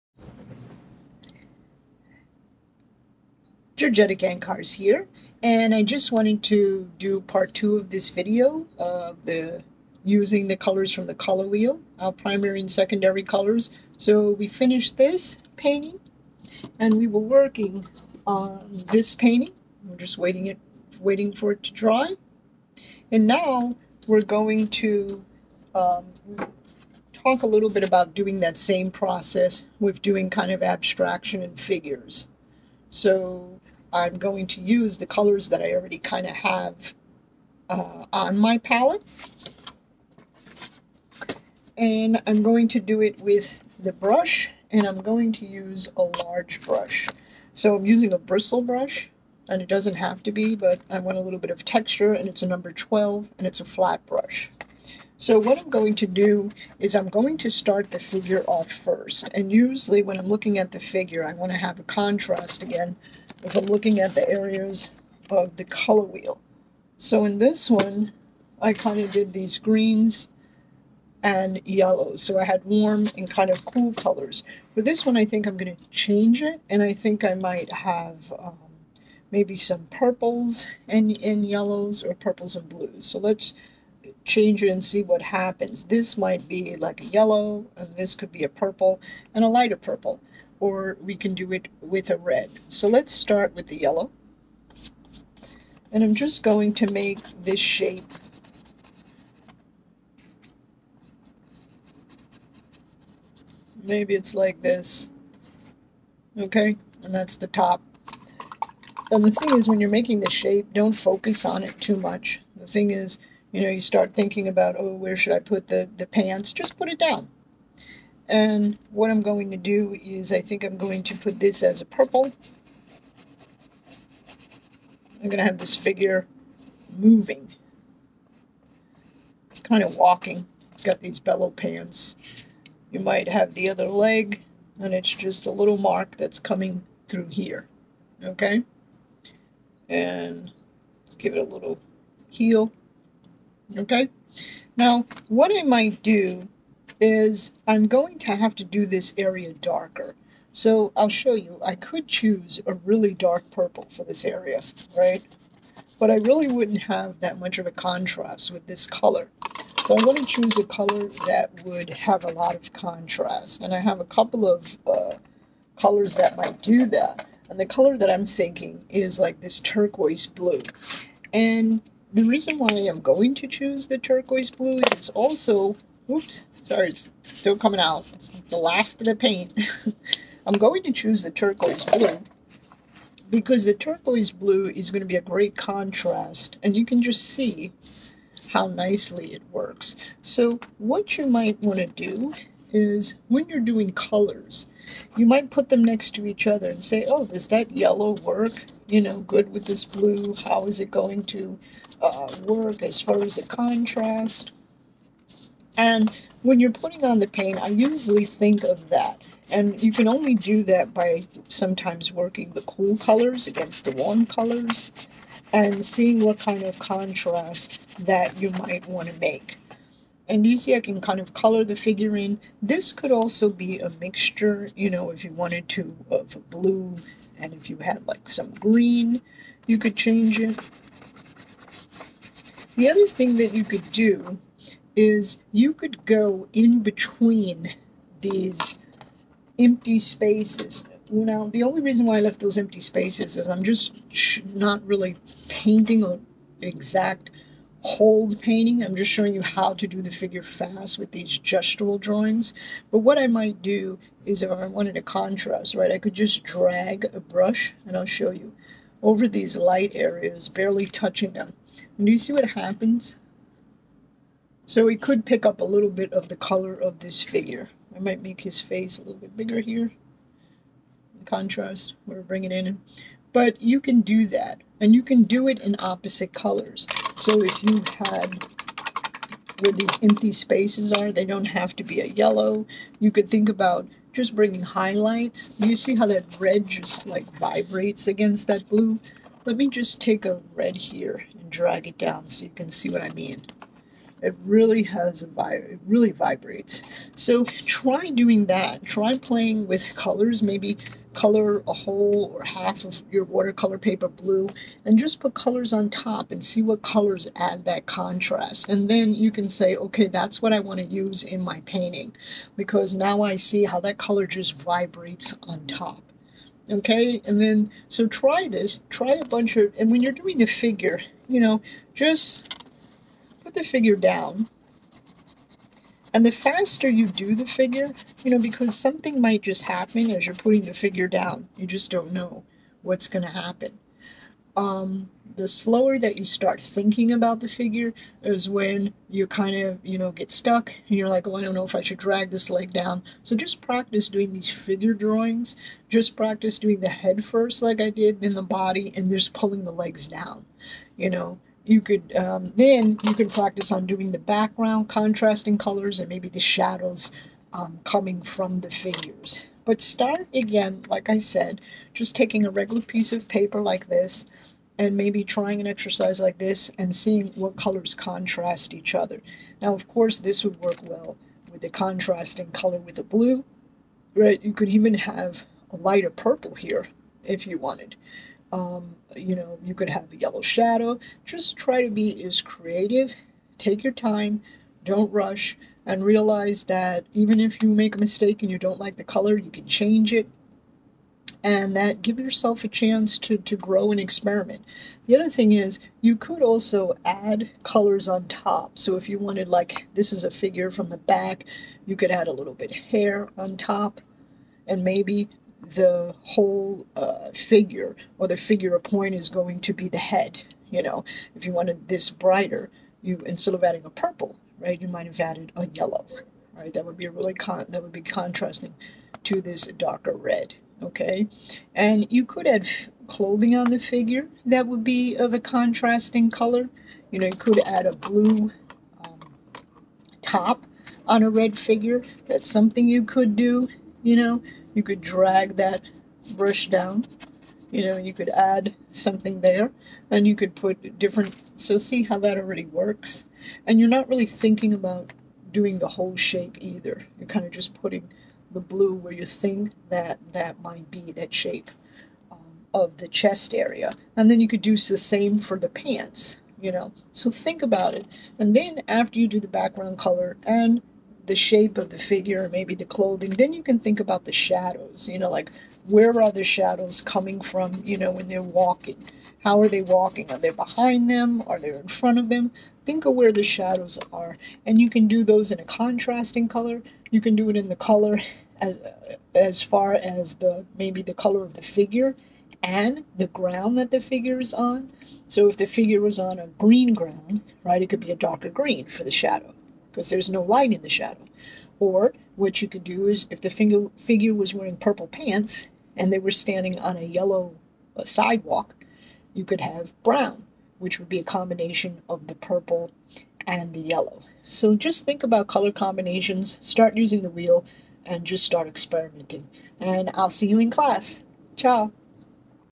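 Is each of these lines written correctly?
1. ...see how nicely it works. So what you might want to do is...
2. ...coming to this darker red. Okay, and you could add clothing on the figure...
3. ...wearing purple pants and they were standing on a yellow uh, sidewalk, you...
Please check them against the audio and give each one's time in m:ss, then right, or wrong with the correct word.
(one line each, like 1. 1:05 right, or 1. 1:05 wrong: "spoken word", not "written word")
1. 3:07 right
2. 6:58 wrong: "contrasting", not "coming"
3. 8:14 right.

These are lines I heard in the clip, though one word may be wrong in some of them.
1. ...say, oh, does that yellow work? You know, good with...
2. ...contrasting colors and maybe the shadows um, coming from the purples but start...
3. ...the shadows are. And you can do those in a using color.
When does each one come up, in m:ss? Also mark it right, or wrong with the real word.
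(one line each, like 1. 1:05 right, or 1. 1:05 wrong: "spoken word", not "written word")
1. 3:16 right
2. 5:54 wrong: "figures", not "purples"
3. 7:53 wrong: "contrasting", not "using".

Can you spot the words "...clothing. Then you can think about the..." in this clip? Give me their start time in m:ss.
7:42.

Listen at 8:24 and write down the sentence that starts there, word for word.
So just think about color combinations, start using the wheel, and just start experimenting.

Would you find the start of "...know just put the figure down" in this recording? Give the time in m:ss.
5:21.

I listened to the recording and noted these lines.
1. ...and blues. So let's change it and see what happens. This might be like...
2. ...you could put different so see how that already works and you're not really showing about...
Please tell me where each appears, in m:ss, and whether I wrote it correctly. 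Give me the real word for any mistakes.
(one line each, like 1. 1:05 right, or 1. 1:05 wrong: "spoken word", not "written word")
1. 1:22 right
2. 7:20 wrong: "thinking", not "showing".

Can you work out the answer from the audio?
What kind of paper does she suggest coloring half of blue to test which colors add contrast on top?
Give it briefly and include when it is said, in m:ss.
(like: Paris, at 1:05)
Watercolor paper, at 5:03.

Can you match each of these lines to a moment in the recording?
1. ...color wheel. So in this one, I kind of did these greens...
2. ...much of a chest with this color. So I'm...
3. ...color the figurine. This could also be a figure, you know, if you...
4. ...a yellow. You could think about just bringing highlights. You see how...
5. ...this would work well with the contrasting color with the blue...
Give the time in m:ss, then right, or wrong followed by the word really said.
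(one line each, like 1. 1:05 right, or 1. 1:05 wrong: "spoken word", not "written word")
1. 1:05 right
2. 2:37 wrong: "contrast", not "chest"
3. 3:41 wrong: "mixture", not "figure"
4. 4:42 right
5. 6:10 right.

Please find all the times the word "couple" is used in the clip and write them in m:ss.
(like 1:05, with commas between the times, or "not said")
2:44.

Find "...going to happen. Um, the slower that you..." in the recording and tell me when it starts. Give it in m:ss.
5:33.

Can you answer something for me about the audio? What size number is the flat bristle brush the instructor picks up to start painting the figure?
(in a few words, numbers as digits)
12.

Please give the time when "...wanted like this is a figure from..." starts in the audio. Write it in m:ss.
6:39.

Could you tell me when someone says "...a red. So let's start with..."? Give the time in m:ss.
1:32.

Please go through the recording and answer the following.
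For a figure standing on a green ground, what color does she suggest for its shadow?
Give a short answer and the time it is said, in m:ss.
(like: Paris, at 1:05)
Darker green, at 8:08.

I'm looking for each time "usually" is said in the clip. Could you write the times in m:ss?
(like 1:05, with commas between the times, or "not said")
0:59, 3:27.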